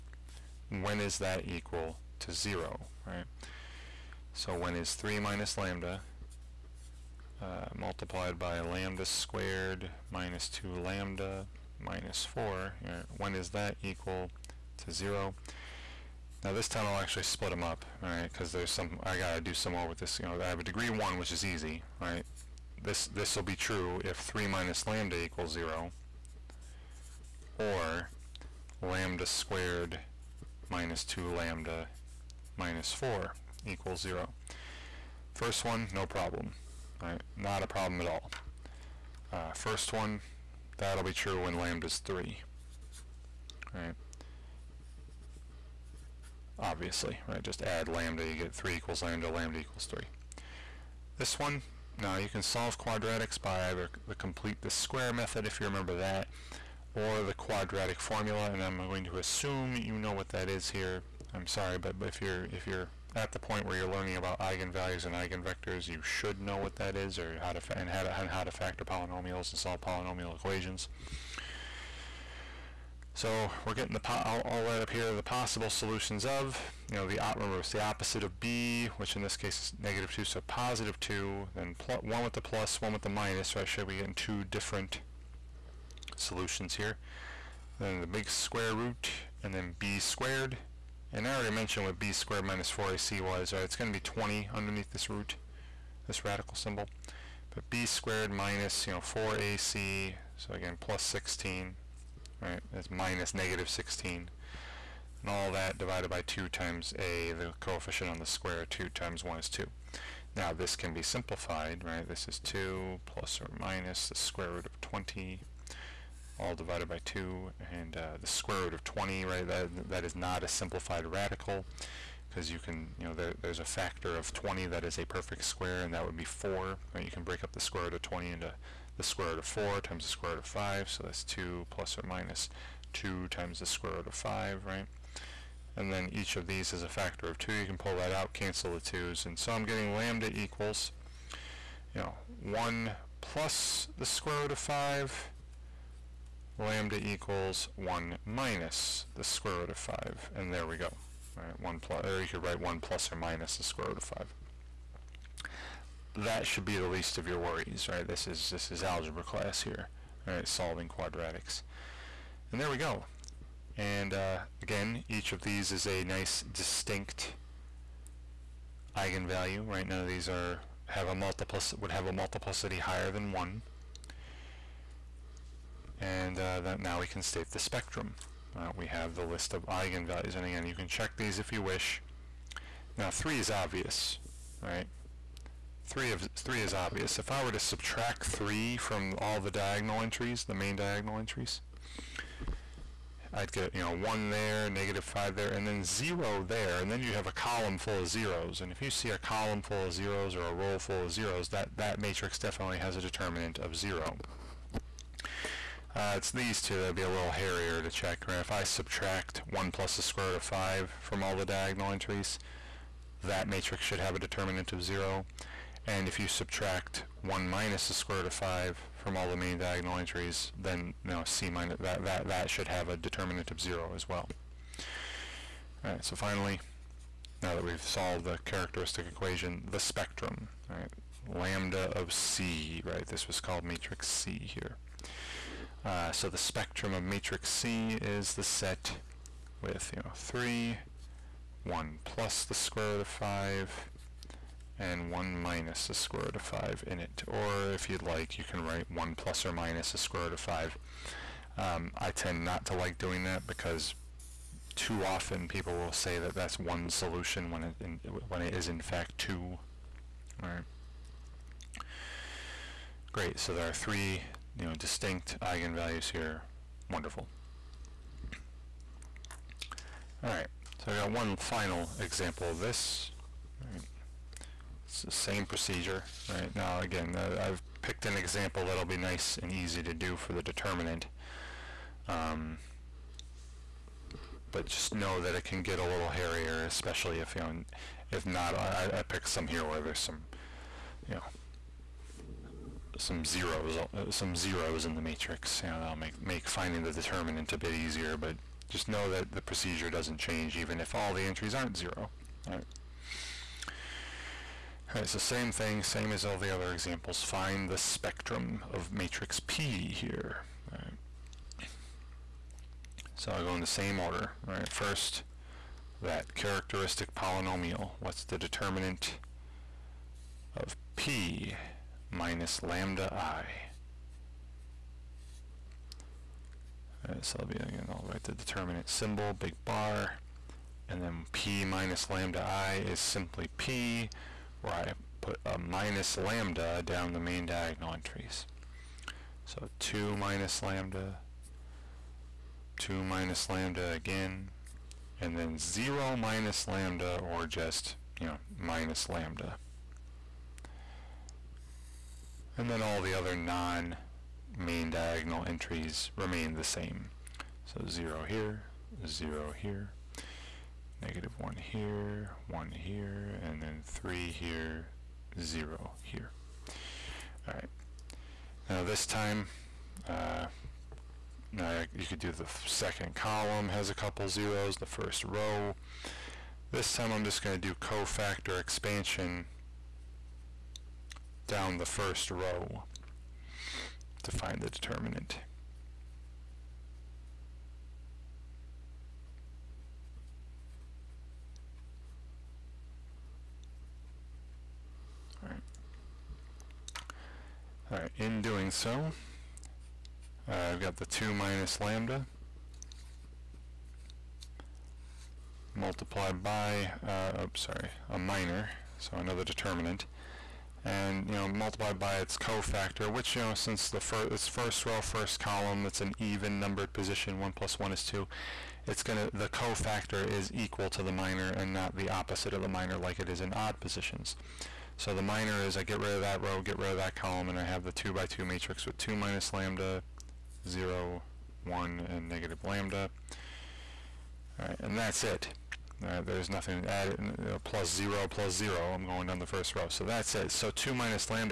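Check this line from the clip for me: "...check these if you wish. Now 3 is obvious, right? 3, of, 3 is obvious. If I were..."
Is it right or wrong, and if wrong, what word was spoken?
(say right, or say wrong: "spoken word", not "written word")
right.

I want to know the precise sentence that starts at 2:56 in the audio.
And uh, now we can state the spectrum.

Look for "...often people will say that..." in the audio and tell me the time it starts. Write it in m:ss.
4:15.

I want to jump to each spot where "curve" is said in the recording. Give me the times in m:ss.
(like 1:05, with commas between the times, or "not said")
not said.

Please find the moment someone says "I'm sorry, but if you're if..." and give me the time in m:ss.
1:01.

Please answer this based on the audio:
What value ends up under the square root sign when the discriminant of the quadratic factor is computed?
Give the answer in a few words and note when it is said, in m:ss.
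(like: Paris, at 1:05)
20, at 1:33.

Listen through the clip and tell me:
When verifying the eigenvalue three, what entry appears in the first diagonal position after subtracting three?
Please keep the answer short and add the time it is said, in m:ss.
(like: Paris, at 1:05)
1, at 3:13.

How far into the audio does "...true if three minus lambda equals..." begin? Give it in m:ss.
0:23.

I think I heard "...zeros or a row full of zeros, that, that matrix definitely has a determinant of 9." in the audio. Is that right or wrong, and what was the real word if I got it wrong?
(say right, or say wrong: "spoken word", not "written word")
wrong: "0", not "9".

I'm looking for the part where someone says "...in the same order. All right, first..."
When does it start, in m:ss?
5:13.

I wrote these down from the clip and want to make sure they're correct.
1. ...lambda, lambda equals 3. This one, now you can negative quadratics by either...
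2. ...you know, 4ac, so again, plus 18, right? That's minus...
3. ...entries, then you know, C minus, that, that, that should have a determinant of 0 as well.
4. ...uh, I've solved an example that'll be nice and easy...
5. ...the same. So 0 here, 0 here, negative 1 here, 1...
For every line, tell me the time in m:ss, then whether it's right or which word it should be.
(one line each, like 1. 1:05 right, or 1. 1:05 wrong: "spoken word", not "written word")
1. 0:49 wrong: "solve", not "negative"
2. 1:38 wrong: "16", not "18"
3. 3:39 right
4. 4:37 wrong: "picked", not "solved"
5. 5:56 right.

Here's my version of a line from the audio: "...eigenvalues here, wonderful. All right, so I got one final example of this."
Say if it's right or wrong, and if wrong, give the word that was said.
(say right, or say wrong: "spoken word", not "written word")
right.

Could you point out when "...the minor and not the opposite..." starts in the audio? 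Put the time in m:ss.
7:01.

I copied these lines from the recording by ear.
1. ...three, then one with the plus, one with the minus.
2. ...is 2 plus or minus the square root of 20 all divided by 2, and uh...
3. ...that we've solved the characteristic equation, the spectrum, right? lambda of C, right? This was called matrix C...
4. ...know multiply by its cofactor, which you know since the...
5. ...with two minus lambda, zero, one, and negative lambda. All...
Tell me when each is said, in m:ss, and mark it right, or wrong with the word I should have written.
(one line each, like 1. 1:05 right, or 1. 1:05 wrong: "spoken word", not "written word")
1. 1:20 wrong: "two", not "three"
2. 1:52 right
3. 3:47 right
4. 6:51 right
5. 7:08 right.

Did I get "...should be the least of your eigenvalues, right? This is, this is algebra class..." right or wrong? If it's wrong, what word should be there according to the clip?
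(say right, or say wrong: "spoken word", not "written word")
wrong: "worries", not "eigenvalues".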